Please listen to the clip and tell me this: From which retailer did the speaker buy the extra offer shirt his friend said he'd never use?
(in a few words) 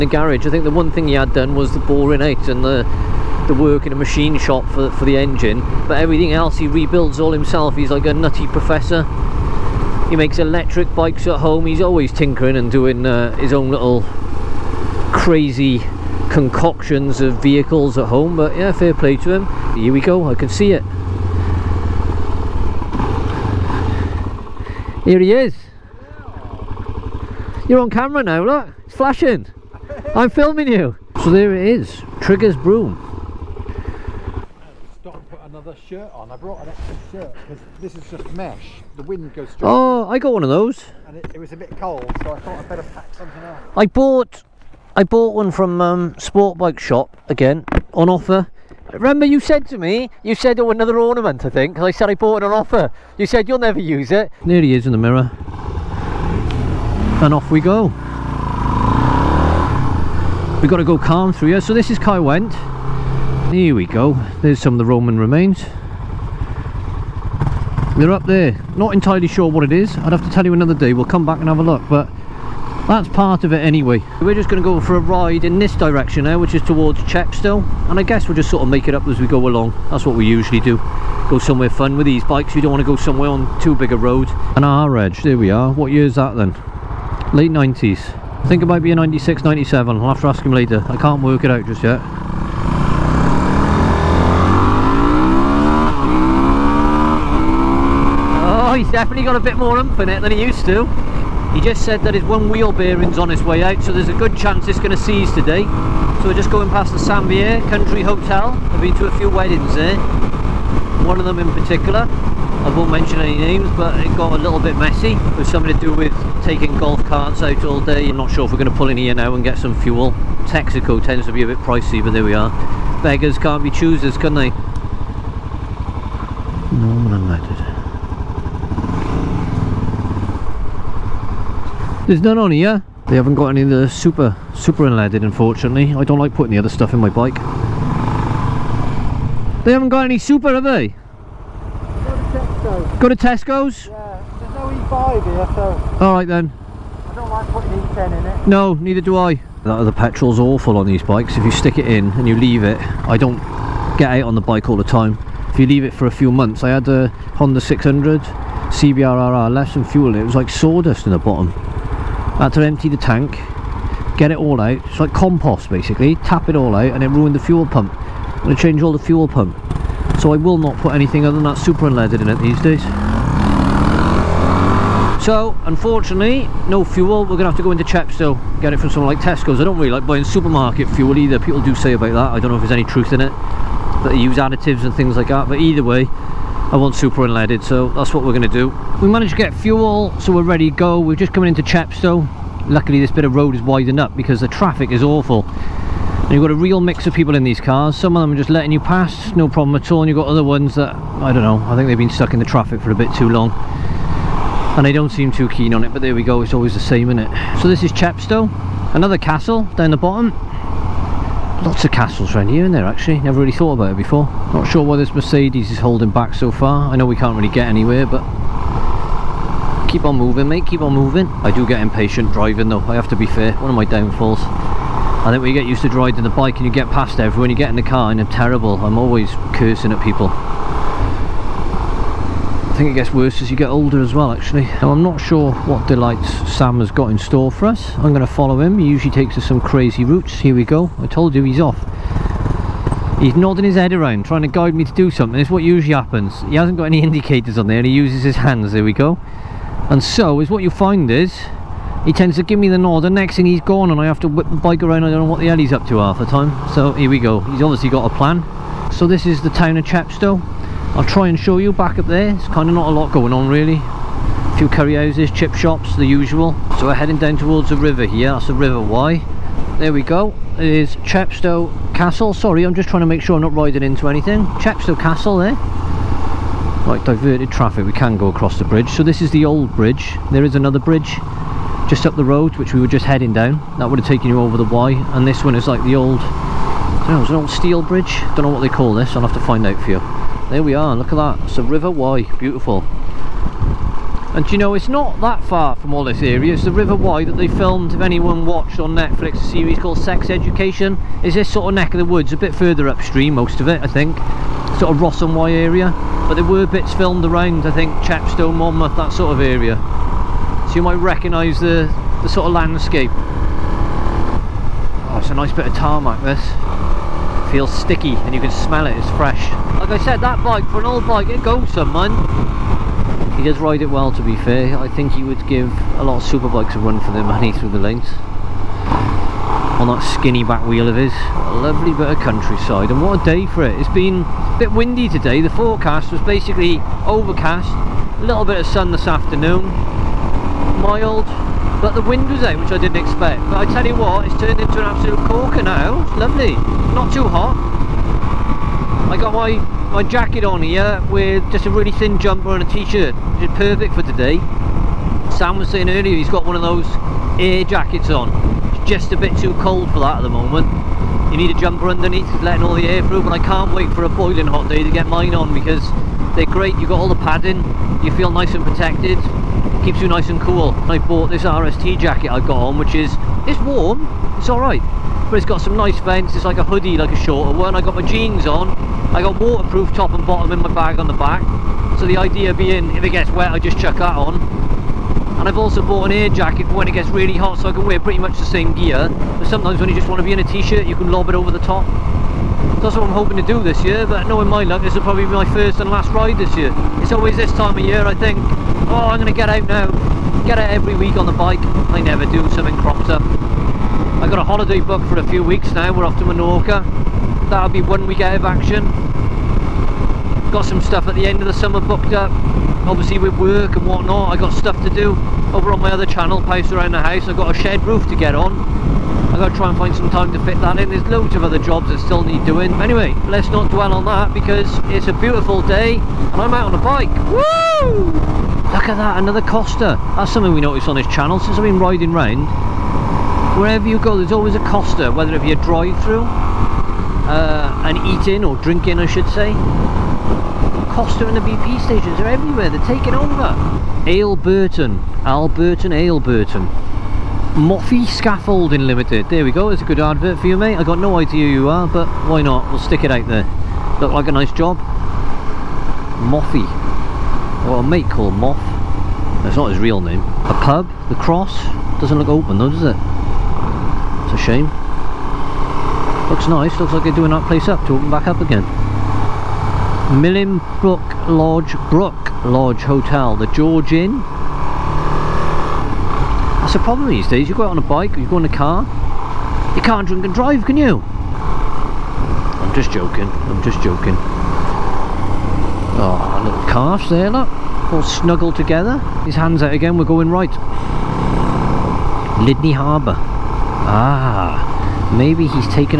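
Sport Bike Shop.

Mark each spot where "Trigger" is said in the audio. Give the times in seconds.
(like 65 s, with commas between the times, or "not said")
32 s.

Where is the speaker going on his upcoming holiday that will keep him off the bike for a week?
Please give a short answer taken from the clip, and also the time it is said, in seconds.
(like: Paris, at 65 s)
Menorca, at 406 s.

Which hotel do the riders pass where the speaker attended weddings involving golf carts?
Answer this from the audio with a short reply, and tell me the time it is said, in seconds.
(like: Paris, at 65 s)
St Pierre Country Hotel, at 106 s.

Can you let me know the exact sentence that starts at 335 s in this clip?
The forecast was basically overcast, a little bit of sun this afternoon, mild, but the wind was out, which I didn't expect.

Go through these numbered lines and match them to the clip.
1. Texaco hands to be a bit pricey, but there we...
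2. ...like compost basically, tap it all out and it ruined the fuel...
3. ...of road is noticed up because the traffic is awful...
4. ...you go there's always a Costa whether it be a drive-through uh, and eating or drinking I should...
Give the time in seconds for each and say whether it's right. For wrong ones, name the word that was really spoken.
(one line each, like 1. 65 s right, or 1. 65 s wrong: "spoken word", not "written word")
1. 120 s wrong: "tends", not "hands"
2. 164 s right
3. 193 s wrong: "widened", not "noticed"
4. 433 s right.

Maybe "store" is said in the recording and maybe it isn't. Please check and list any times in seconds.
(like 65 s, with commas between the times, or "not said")
237 s.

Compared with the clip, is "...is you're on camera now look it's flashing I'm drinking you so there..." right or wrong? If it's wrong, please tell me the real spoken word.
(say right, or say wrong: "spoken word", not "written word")
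wrong: "filming", not "drinking".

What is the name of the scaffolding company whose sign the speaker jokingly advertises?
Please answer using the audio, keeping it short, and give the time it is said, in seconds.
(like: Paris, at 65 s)
Moffy Scaffolding Limited, at 447 s.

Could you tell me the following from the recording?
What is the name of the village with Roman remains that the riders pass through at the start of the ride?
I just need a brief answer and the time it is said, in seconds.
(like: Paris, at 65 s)
Caerwent, at 61 s.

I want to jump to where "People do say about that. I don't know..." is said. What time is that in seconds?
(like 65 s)
181 s.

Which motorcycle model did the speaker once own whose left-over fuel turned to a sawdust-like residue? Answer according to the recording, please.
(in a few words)
Honda 600 CBR.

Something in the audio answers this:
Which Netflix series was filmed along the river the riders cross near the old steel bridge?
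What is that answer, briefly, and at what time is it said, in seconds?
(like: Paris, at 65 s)
Sex Education, at 299 s.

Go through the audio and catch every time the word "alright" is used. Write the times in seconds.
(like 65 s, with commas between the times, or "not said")
146 s, 374 s.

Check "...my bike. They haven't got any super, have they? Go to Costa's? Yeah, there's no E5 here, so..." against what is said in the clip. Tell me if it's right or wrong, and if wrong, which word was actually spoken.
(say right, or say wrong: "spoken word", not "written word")
wrong: "Tesco", not "Costa".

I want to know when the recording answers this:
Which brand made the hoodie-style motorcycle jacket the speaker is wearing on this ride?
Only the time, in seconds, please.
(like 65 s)
371 s.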